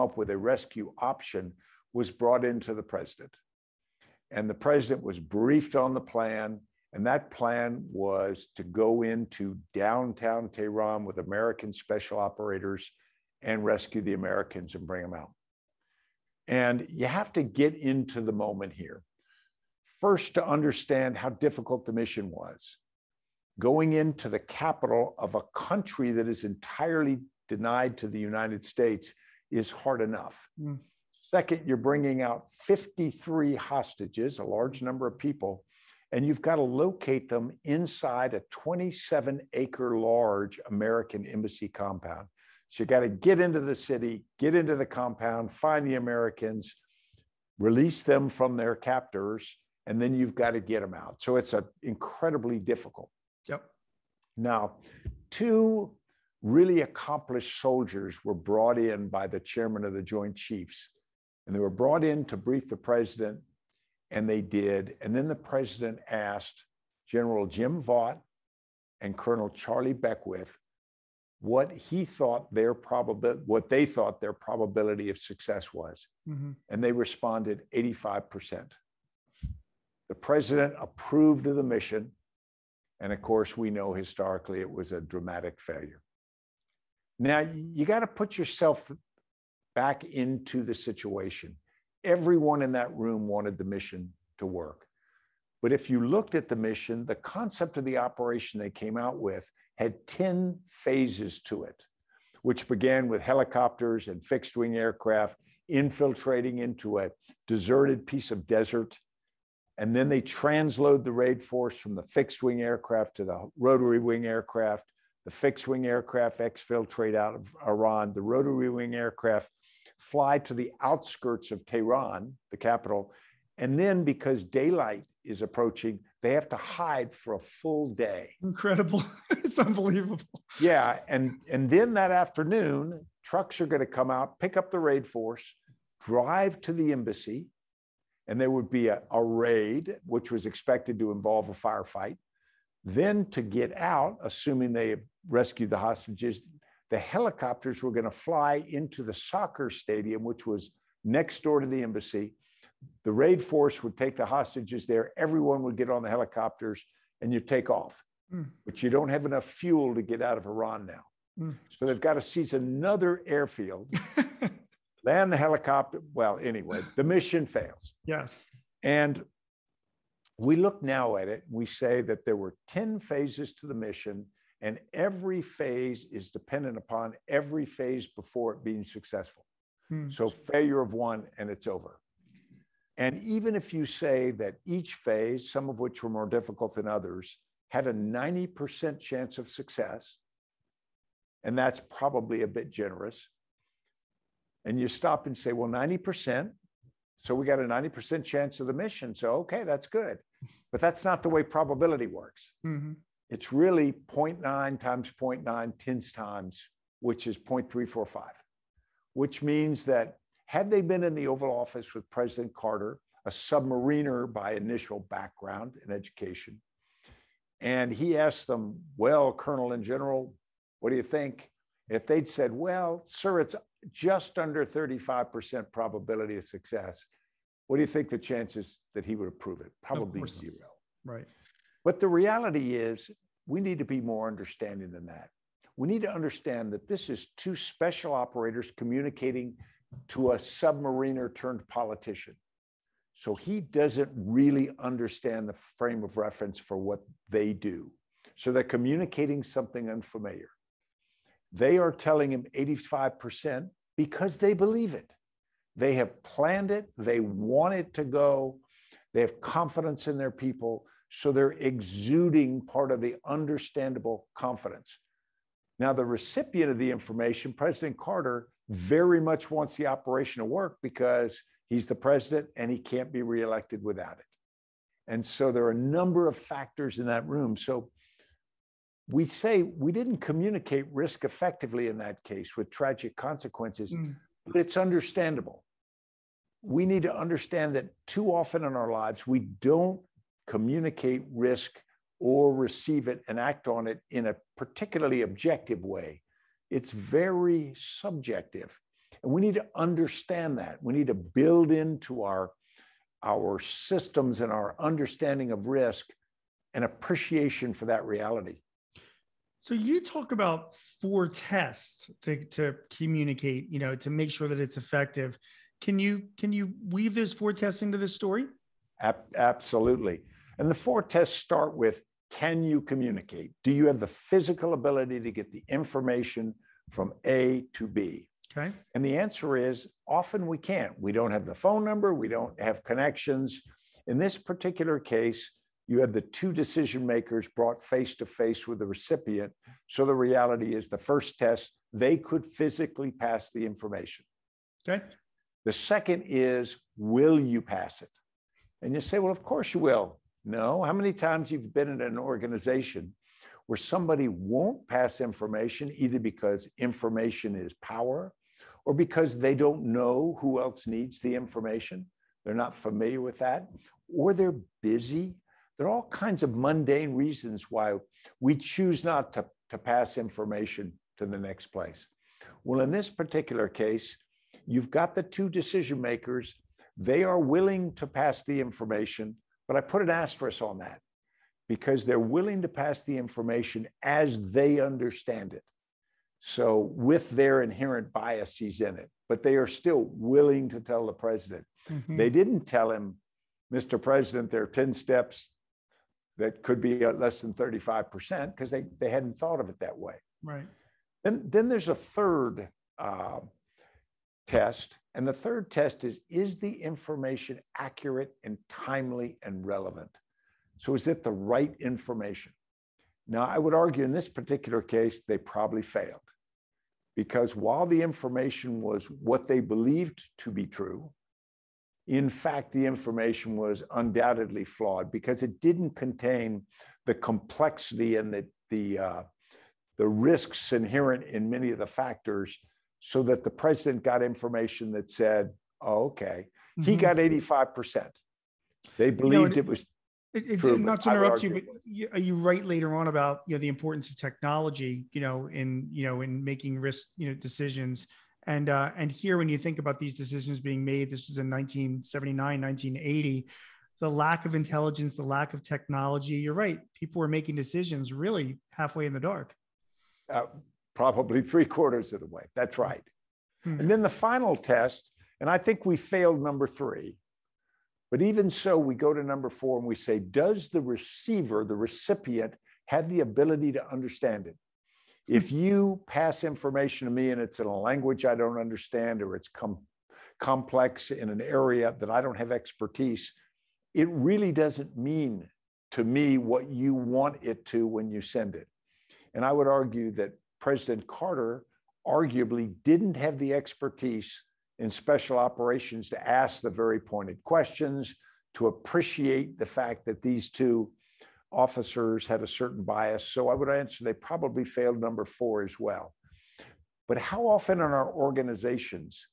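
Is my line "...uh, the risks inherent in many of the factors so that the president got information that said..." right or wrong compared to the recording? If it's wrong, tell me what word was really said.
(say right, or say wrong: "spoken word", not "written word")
right.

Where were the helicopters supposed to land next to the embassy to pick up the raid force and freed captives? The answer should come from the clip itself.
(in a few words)
soccer stadium.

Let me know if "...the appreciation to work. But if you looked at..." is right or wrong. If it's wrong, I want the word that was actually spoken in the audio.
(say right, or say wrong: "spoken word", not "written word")
wrong: "mission", not "appreciation".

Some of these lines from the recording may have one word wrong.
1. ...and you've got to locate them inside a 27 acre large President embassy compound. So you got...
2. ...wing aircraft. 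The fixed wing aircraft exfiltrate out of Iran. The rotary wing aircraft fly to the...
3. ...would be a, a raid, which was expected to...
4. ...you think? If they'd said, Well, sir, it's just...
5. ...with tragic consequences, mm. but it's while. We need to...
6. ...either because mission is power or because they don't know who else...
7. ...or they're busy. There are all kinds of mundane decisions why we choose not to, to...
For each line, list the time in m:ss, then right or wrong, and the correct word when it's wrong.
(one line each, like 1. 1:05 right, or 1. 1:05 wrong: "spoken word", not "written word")
1. 0:36 wrong: "American", not "President"
2. 1:53 right
3. 2:18 right
4. 3:40 right
5. 4:42 wrong: "understandable", not "while"
6. 5:55 wrong: "information", not "mission"
7. 6:04 wrong: "reasons", not "decisions".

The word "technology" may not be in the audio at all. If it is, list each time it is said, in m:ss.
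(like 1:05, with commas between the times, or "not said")
7:24, 7:35.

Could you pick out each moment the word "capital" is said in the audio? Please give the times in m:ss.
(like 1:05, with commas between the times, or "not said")
0:24, 2:02.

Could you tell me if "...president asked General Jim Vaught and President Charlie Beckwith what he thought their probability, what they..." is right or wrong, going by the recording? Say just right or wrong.
wrong.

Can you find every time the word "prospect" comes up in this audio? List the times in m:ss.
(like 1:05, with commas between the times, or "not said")
not said.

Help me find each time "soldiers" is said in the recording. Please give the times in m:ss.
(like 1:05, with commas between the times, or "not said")
0:57.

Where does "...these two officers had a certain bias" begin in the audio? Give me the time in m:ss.
8:20.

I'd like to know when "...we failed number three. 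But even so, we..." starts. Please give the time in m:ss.
7:45.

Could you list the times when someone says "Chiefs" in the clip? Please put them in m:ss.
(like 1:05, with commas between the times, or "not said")
1:00.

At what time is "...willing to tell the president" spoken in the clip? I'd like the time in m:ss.
6:30.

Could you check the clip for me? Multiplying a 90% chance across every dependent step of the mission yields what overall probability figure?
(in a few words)
0.345.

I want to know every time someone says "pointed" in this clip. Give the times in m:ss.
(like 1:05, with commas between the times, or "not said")
8:16.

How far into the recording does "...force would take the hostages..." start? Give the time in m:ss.
2:33.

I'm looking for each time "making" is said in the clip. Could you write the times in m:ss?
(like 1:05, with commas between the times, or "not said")
7:26, 7:37.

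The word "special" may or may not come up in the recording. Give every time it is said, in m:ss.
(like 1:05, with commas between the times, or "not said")
0:11, 3:57, 8:14.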